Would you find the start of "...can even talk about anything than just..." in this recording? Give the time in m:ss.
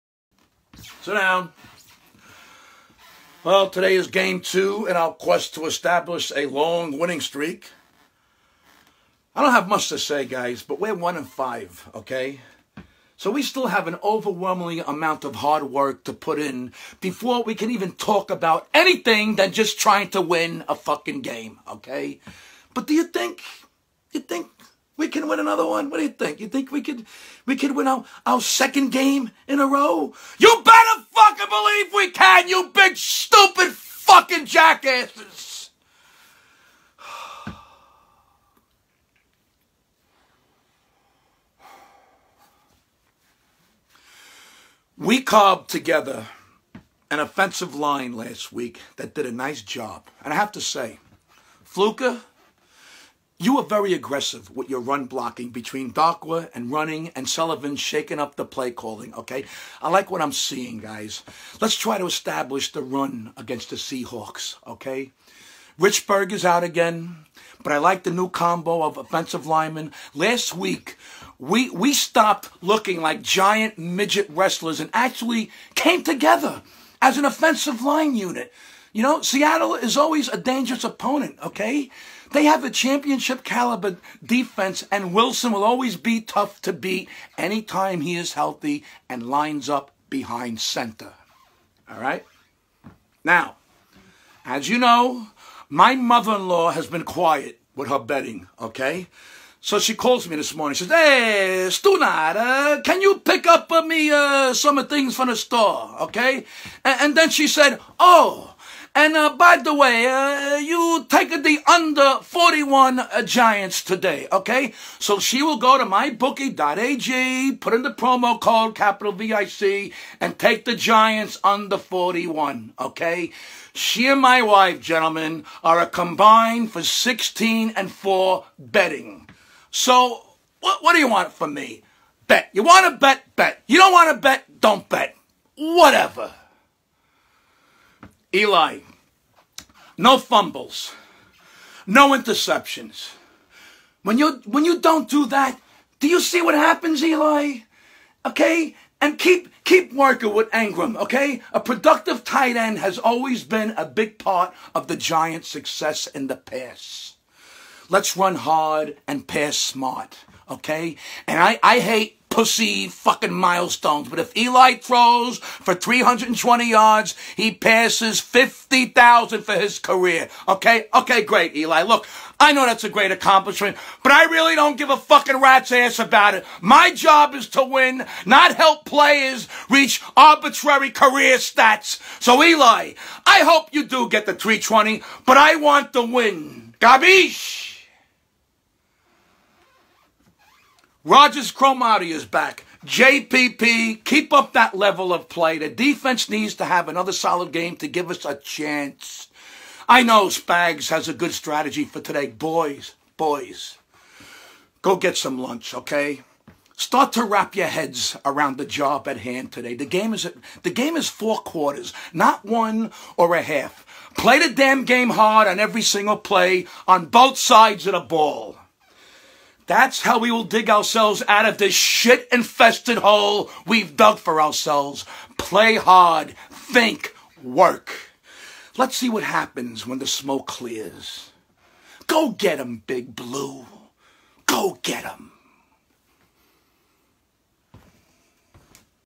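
0:17.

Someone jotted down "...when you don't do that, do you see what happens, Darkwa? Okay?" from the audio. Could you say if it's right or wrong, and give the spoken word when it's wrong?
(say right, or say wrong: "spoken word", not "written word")
wrong: "Eli", not "Darkwa".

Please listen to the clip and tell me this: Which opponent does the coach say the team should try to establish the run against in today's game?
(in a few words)
Seahawks.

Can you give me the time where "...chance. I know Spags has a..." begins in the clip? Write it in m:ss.
3:18.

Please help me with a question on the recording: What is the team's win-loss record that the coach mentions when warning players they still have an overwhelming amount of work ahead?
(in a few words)
1 and 5.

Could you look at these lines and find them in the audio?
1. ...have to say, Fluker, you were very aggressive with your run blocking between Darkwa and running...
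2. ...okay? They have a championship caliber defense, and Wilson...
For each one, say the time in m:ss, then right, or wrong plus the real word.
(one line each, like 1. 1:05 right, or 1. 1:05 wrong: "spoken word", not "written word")
1. 0:50 right
2. 1:21 right.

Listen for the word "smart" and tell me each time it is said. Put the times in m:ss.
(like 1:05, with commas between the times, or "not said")
2:39.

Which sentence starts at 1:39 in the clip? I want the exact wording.
So she calls me this morning.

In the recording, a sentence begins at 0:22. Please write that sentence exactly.
But do you think, you think we can win another one.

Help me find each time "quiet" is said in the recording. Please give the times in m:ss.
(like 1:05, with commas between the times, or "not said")
1:37.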